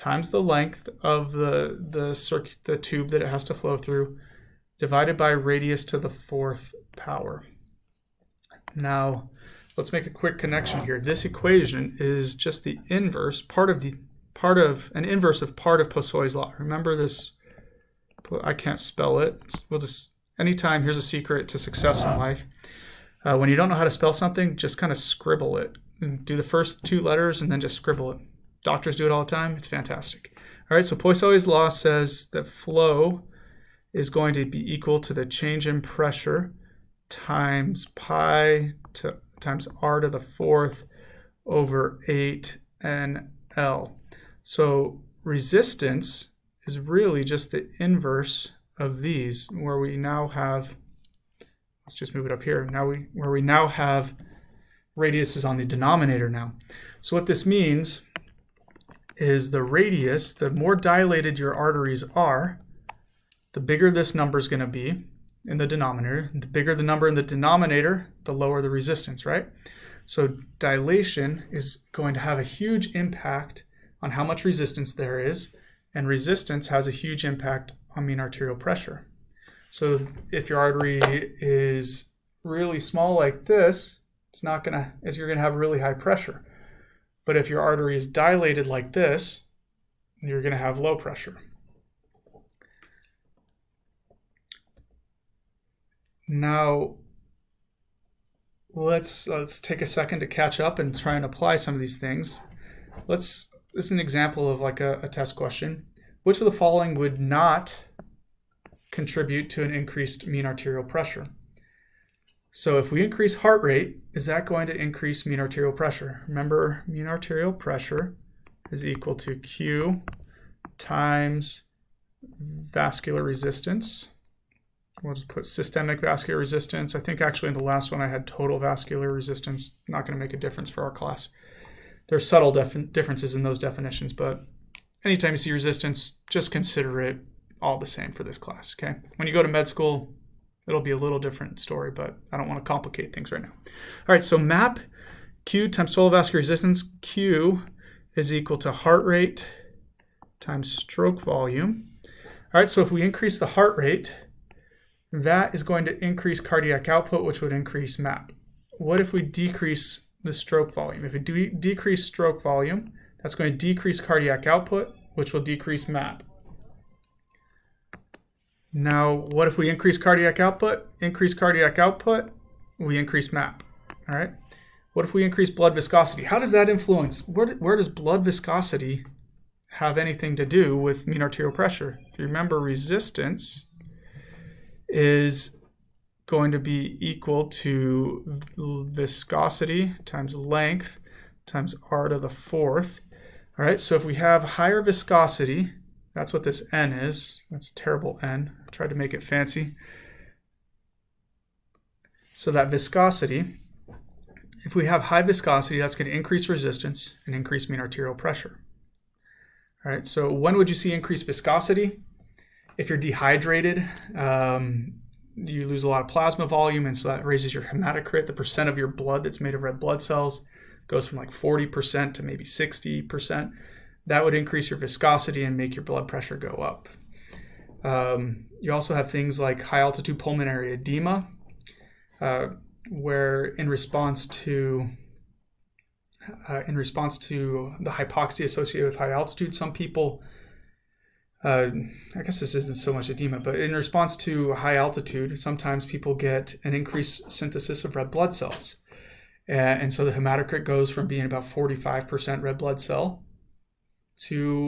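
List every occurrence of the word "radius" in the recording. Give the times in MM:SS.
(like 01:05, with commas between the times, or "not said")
00:05, 00:54, 00:59.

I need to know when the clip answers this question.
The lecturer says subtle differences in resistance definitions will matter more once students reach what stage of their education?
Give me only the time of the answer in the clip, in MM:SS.
02:19.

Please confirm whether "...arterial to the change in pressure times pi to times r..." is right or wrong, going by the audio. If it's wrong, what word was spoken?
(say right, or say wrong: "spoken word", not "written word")
wrong: "equal", not "arterial".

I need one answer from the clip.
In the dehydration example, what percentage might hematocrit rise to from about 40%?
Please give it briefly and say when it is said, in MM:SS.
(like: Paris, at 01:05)
60%, at 03:42.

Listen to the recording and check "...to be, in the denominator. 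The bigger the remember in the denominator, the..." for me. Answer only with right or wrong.
wrong.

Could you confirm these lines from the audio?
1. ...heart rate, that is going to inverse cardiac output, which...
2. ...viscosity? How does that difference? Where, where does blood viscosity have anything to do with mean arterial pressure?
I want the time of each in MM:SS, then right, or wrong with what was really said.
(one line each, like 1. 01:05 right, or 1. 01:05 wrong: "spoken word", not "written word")
1. 02:33 wrong: "increase", not "inverse"
2. 02:55 wrong: "influence", not "difference".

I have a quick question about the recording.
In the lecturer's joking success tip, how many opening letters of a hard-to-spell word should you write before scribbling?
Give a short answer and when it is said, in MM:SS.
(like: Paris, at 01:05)
2, at 00:26.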